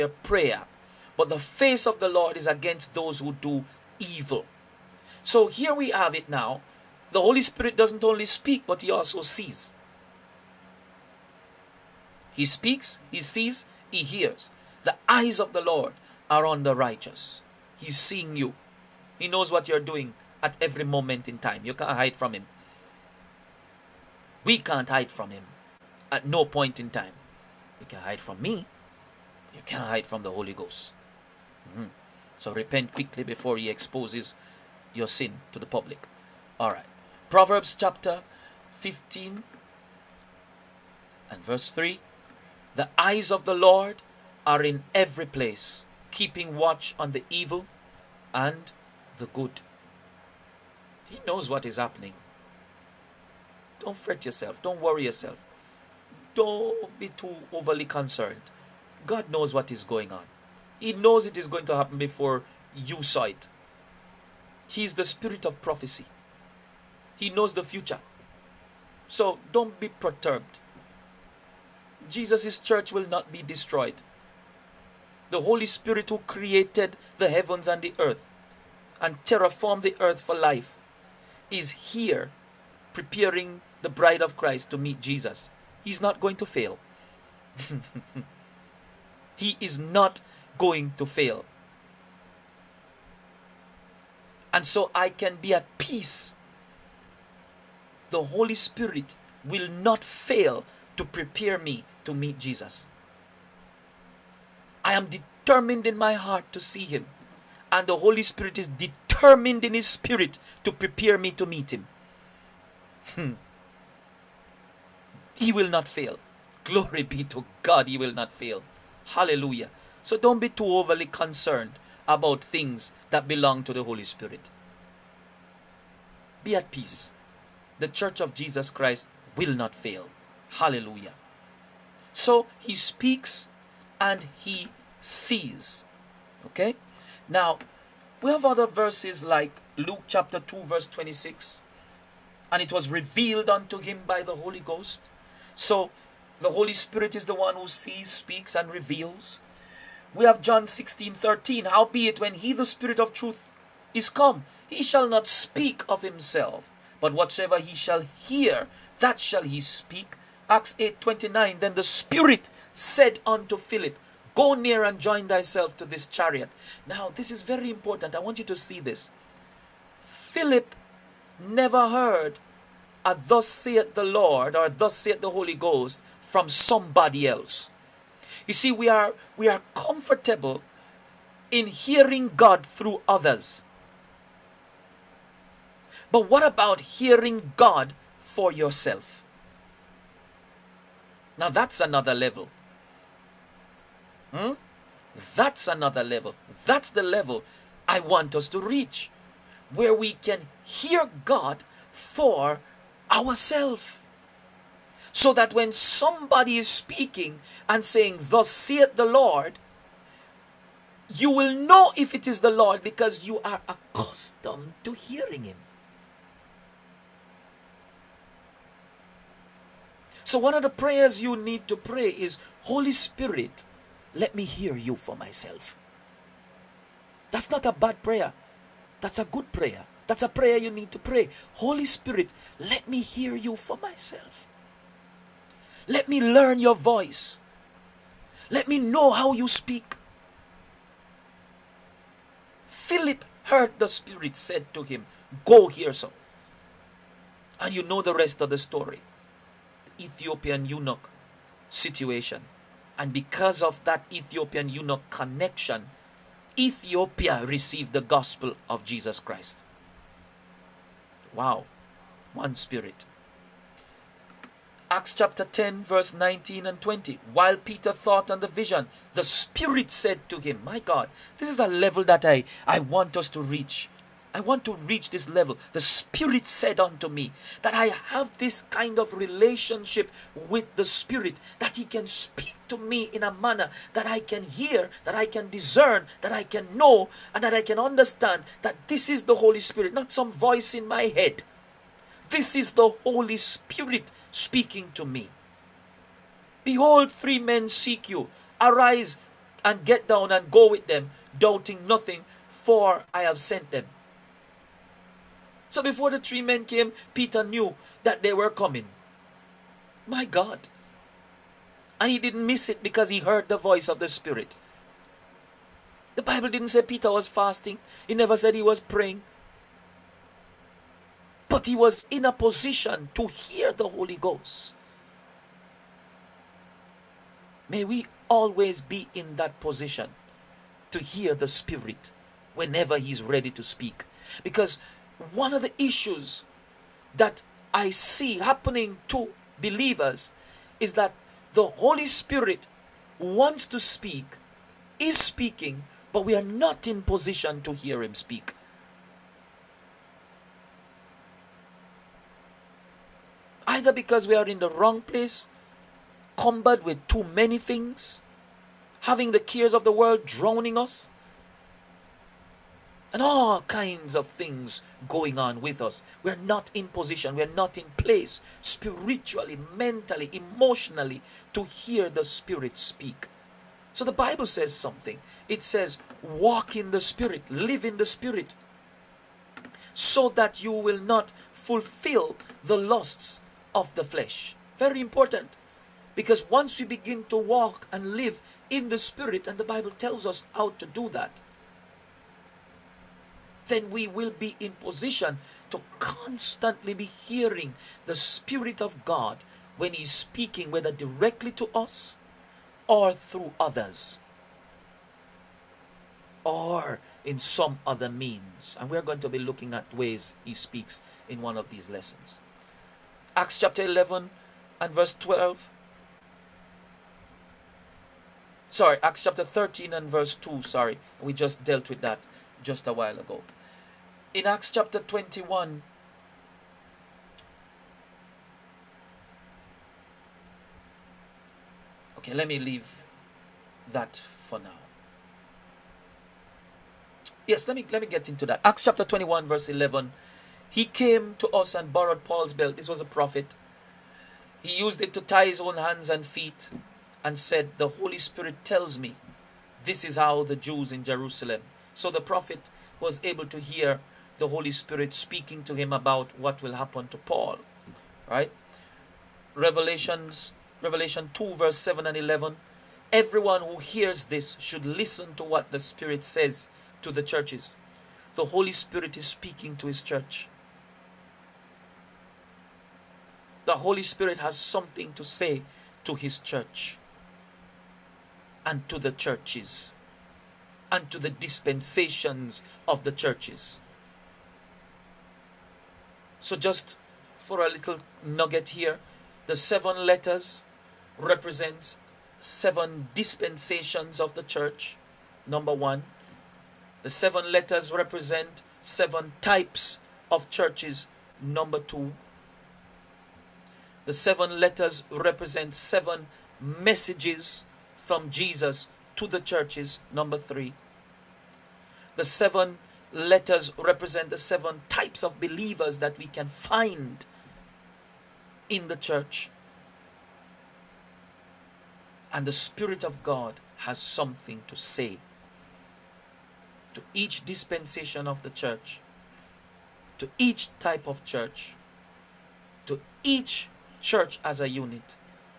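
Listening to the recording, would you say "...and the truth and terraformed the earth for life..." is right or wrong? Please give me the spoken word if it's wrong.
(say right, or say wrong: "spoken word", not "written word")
wrong: "earth", not "truth".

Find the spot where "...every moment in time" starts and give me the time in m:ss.
0:20.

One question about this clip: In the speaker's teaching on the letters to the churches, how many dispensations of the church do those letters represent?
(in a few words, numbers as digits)
7.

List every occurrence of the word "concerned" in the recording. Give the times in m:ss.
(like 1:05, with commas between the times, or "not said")
0:57, 2:01.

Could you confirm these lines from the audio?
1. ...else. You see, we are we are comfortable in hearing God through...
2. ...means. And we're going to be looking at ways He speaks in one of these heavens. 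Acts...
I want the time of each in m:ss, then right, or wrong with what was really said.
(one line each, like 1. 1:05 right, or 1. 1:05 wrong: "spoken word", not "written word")
1. 2:57 right
2. 6:48 wrong: "lessons", not "heavens".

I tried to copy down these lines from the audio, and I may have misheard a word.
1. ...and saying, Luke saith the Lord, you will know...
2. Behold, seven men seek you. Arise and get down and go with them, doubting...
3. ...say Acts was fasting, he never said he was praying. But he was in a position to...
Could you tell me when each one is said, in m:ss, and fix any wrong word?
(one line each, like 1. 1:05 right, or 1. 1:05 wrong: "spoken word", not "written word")
1. 3:27 wrong: "Thus", not "Luke"
2. 4:56 wrong: "three", not "seven"
3. 5:16 wrong: "Peter", not "Acts".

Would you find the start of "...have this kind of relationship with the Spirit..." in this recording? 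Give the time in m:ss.
4:37.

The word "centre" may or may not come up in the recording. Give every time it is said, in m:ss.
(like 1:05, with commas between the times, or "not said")
not said.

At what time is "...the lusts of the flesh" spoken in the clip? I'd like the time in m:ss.
6:22.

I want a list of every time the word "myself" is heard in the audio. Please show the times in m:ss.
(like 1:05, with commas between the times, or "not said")
3:45, 3:53.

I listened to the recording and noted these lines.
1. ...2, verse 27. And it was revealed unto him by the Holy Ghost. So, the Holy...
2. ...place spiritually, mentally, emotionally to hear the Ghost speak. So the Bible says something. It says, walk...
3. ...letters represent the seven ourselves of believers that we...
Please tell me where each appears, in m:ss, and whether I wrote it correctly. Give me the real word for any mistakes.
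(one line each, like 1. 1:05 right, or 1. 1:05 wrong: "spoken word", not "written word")
1. 2:20 wrong: "26", not "27"
2. 6:07 wrong: "Spirit", not "Ghost"
3. 8:33 wrong: "types", not "ourselves".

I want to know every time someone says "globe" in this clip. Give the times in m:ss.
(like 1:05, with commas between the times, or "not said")
not said.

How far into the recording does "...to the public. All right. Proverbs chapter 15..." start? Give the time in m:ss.
0:35.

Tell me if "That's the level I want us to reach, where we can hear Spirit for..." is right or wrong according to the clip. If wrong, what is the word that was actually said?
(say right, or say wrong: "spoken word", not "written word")
wrong: "God", not "Spirit".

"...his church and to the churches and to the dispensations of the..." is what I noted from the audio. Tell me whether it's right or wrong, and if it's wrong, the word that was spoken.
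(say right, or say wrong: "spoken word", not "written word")
right.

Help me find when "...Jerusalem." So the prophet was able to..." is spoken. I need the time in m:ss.
7:31.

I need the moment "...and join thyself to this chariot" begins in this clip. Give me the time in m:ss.
2:44.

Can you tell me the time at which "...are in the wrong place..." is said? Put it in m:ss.
5:54.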